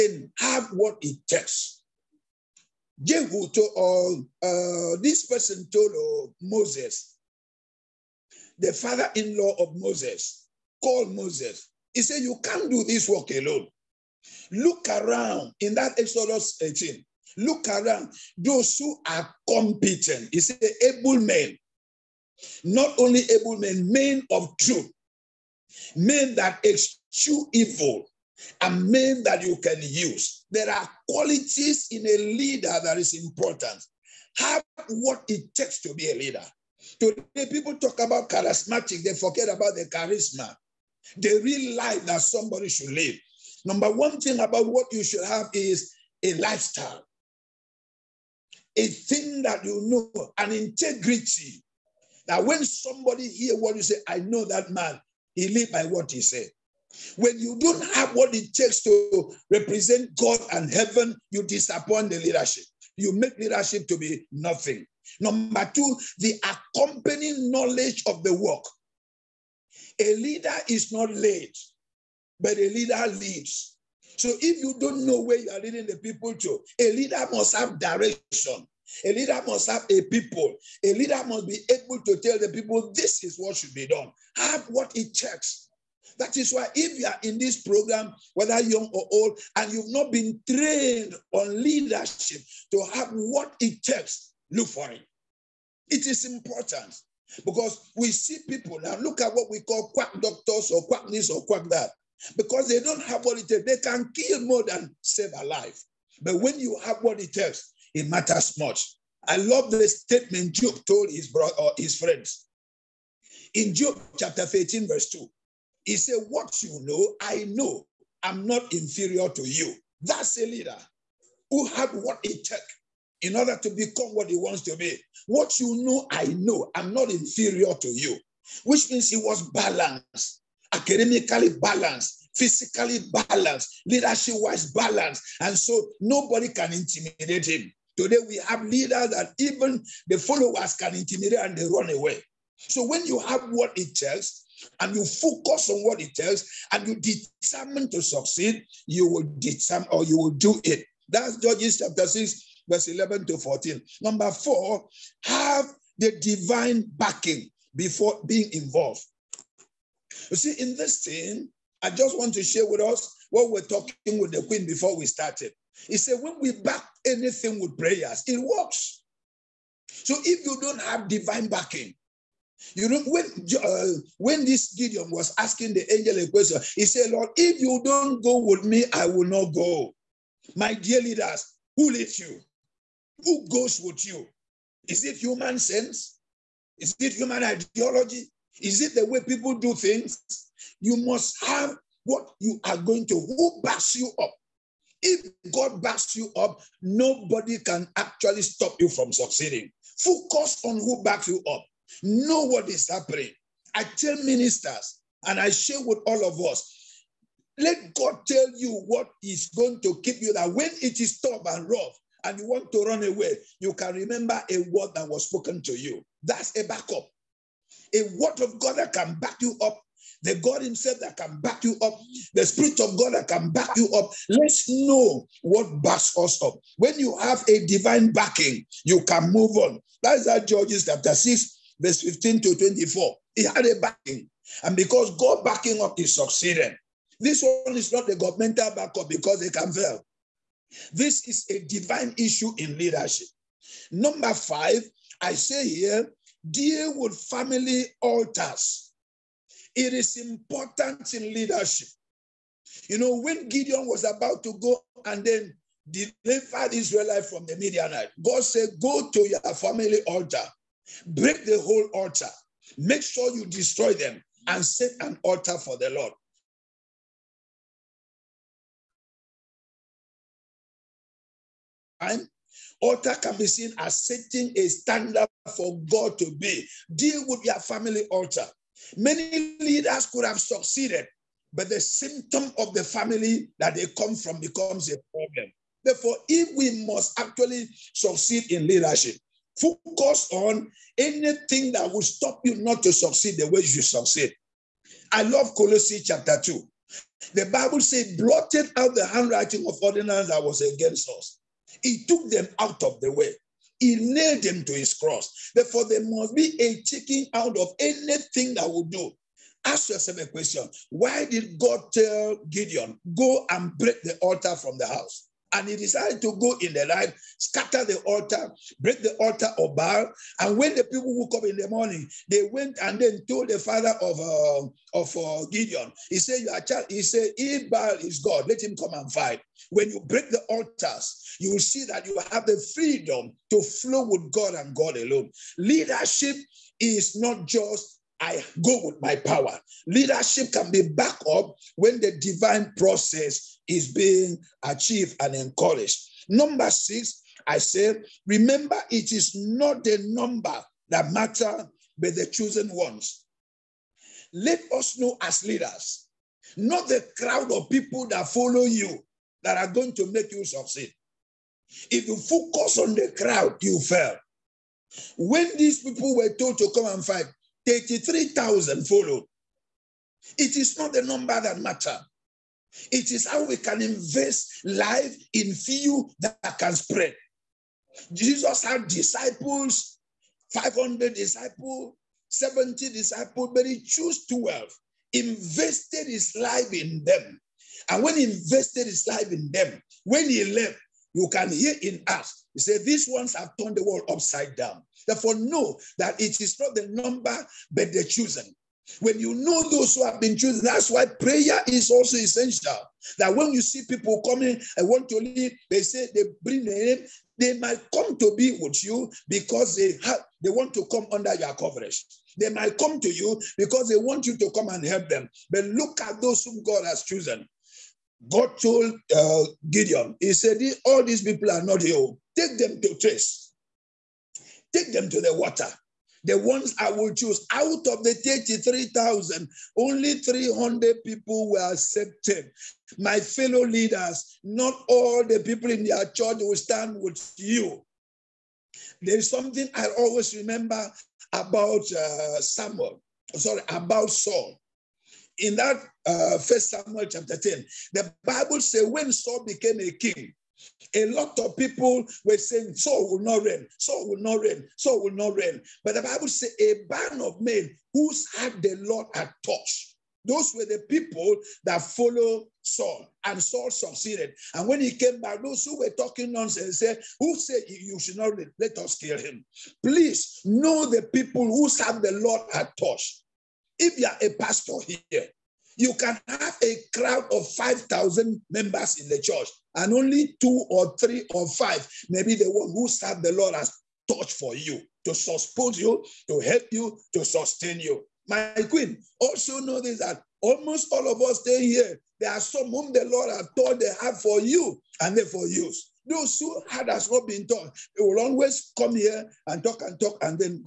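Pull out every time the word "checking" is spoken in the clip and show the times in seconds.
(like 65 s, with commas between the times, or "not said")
306 s.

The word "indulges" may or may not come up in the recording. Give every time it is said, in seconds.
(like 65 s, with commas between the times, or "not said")
not said.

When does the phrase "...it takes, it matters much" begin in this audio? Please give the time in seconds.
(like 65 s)
107 s.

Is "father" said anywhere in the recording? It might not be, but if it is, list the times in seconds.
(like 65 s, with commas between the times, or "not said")
8 s, 323 s.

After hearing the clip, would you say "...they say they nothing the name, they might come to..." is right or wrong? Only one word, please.
wrong.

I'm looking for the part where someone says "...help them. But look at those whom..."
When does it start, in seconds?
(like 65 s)
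414 s.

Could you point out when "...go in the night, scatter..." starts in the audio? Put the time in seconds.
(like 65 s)
316 s.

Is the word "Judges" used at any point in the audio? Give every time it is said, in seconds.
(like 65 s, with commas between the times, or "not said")
151 s, 230 s.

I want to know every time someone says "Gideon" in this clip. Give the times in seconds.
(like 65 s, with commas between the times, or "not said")
174 s, 253 s, 312 s, 325 s, 419 s.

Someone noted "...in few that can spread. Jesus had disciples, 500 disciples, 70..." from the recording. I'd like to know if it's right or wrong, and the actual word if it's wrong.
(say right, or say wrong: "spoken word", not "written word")
right.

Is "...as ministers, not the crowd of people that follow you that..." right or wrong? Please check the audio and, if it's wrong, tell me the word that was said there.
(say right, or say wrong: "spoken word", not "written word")
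wrong: "leaders", not "ministers".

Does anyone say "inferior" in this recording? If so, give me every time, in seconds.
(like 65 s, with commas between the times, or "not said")
118 s, 127 s.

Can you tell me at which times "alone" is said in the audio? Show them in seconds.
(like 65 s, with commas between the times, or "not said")
13 s, 334 s.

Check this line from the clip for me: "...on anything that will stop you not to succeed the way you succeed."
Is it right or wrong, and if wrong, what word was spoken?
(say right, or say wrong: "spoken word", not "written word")
right.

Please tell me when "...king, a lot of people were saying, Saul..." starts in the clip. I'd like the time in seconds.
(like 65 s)
449 s.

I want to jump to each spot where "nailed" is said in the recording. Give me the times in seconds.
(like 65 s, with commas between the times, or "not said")
303 s.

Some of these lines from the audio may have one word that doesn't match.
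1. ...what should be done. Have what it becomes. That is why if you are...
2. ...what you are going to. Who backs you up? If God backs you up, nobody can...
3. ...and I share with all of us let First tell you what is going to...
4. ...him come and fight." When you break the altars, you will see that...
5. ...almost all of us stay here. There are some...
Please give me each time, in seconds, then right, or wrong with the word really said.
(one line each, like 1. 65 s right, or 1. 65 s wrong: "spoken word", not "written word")
1. 83 s wrong: "takes", not "becomes"
2. 192 s right
3. 205 s wrong: "God", not "First"
4. 328 s right
5. 490 s right.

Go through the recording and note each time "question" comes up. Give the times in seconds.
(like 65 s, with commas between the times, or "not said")
176 s, 310 s.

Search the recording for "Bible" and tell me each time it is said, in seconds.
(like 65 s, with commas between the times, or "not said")
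297 s, 448 s, 456 s.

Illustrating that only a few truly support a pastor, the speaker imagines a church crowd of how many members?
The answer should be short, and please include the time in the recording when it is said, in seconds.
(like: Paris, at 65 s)
5,000, at 477 s.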